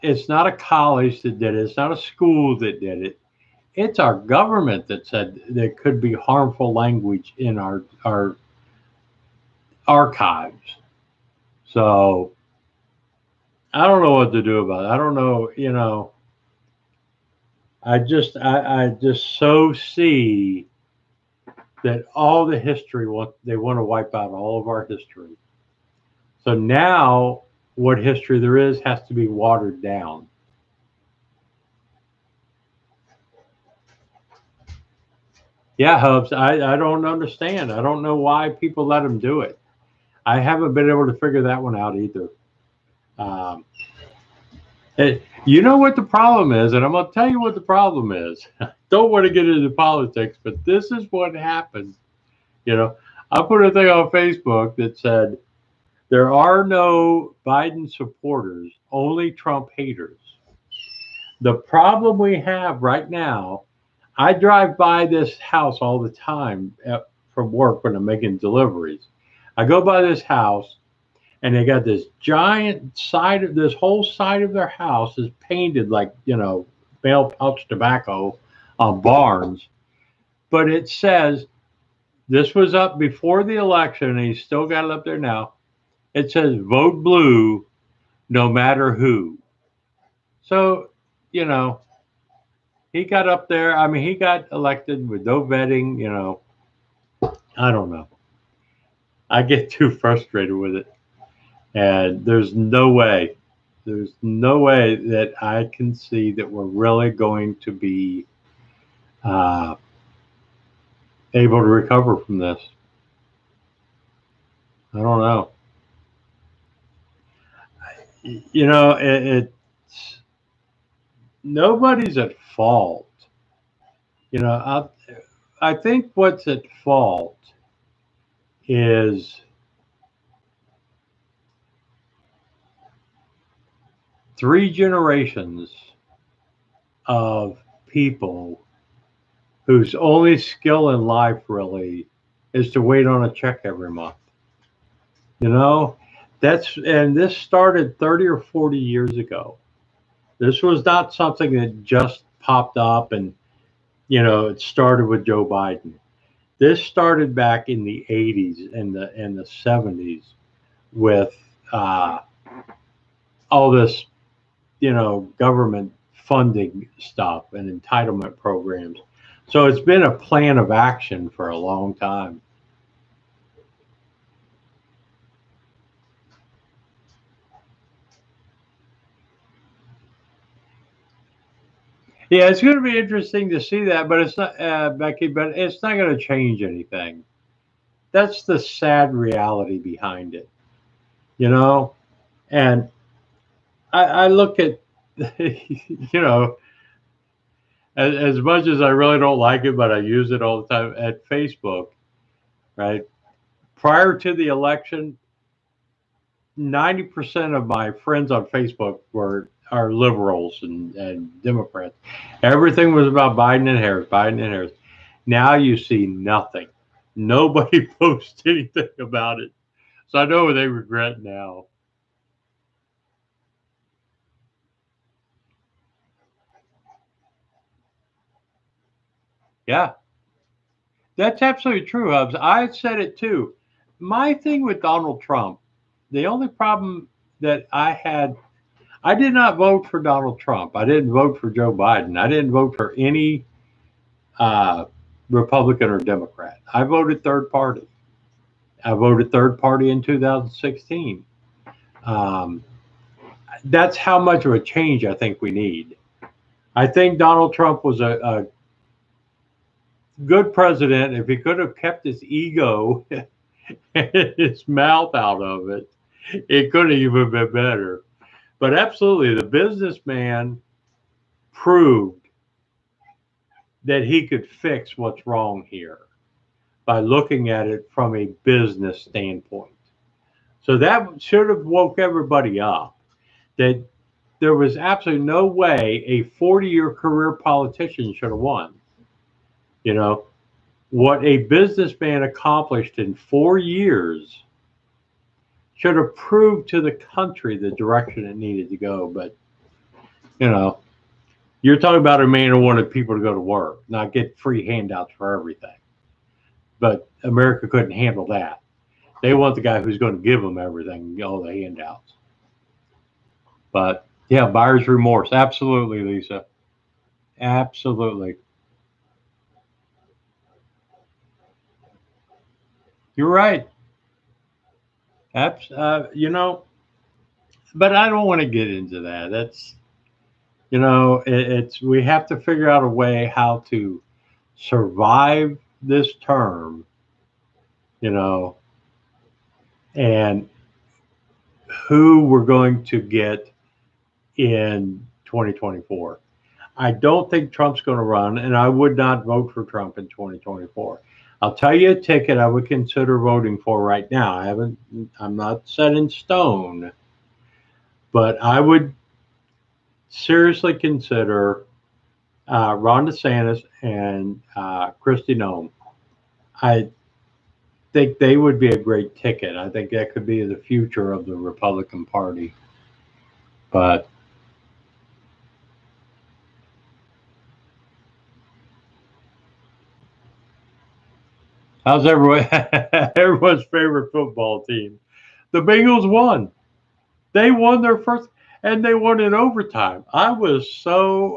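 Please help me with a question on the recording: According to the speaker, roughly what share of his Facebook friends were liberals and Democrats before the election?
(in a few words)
90%.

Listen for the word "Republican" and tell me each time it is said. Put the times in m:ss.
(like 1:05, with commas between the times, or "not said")
4:05, 6:11.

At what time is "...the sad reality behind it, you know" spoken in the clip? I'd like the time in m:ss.
3:08.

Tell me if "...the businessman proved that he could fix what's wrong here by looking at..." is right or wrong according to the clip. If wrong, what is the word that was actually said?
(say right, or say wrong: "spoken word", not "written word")
right.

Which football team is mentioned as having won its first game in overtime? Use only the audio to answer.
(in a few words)
The Bengals.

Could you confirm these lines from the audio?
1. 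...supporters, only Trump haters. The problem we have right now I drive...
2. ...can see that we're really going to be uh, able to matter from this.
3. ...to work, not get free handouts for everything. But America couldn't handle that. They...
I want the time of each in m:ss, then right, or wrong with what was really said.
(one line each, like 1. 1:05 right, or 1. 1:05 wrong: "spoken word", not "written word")
1. 0:57 right
2. 1:45 wrong: "recover", not "matter"
3. 5:03 right.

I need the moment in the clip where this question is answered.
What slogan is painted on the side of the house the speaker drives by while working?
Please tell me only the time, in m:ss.
1:26.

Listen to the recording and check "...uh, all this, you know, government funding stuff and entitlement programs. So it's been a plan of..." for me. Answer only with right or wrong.
right.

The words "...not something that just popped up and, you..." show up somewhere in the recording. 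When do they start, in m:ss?
2:30.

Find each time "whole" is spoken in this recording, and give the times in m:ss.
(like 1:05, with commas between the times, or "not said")
1:13.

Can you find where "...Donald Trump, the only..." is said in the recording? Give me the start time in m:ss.
3:54.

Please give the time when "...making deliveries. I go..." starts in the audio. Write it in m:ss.
1:08.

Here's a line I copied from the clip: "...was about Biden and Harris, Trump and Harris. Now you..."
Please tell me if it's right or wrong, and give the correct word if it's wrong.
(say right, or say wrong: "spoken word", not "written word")
wrong: "Biden", not "Trump".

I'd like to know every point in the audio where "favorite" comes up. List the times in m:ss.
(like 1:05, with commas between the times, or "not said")
6:23.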